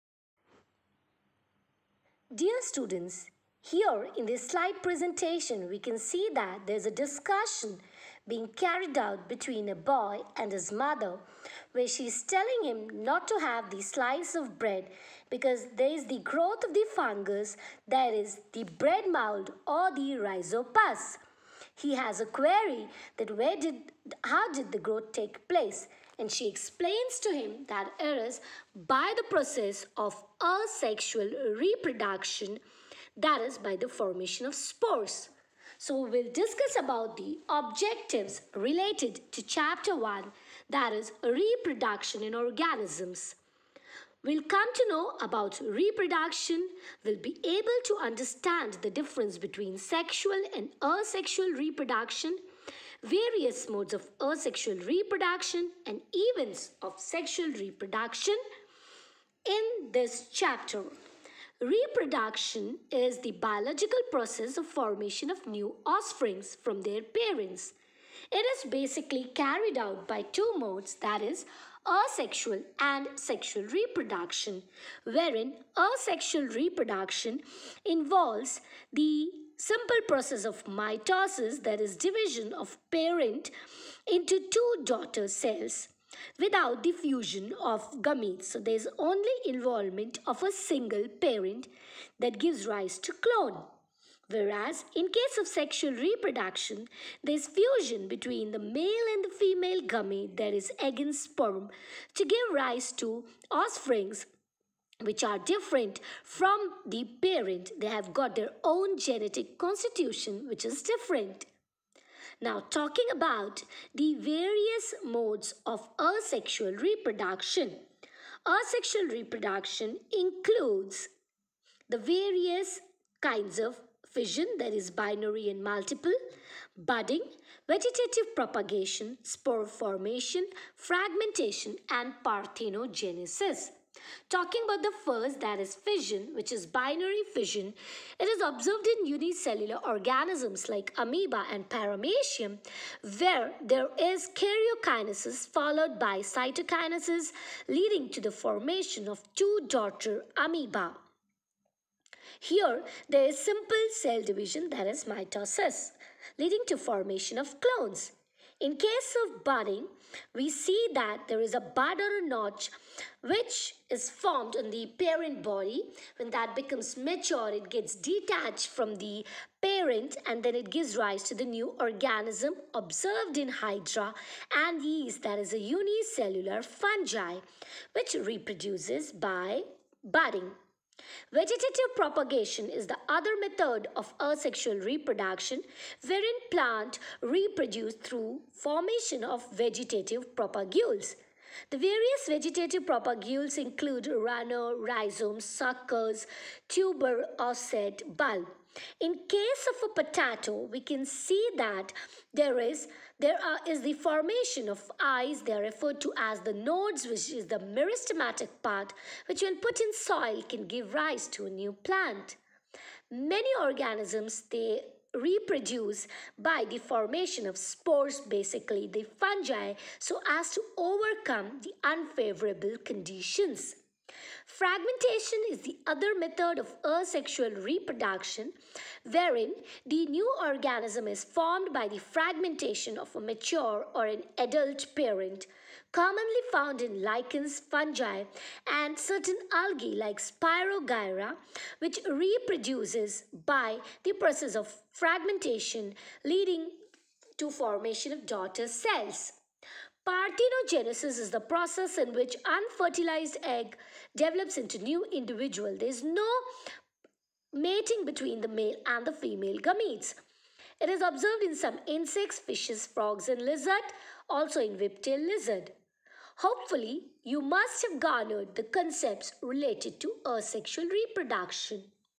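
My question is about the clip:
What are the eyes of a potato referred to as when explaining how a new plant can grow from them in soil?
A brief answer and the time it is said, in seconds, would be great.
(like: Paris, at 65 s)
Nodes, at 206 s.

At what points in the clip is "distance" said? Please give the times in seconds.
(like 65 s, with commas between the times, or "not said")
not said.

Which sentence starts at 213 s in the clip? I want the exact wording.
Many organisms, they reproduce by the formation of spores, basically the fungi, so as to overcome the unfavorable conditions.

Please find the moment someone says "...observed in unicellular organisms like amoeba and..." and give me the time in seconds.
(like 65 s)
138 s.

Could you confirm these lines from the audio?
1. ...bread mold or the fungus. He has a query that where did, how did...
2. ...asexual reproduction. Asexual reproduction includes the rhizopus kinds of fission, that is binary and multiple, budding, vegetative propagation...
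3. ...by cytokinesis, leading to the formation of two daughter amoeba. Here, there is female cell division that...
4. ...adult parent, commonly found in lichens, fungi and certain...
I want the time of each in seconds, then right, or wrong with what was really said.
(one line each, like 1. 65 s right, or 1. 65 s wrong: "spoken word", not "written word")
1. 18 s wrong: "rhizopus", not "fungus"
2. 115 s wrong: "various", not "rhizopus"
3. 145 s wrong: "simple", not "female"
4. 234 s right.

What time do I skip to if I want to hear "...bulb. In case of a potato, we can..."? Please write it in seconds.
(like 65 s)
198 s.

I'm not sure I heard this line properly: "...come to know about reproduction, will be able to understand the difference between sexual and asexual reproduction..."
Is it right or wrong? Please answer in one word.
right.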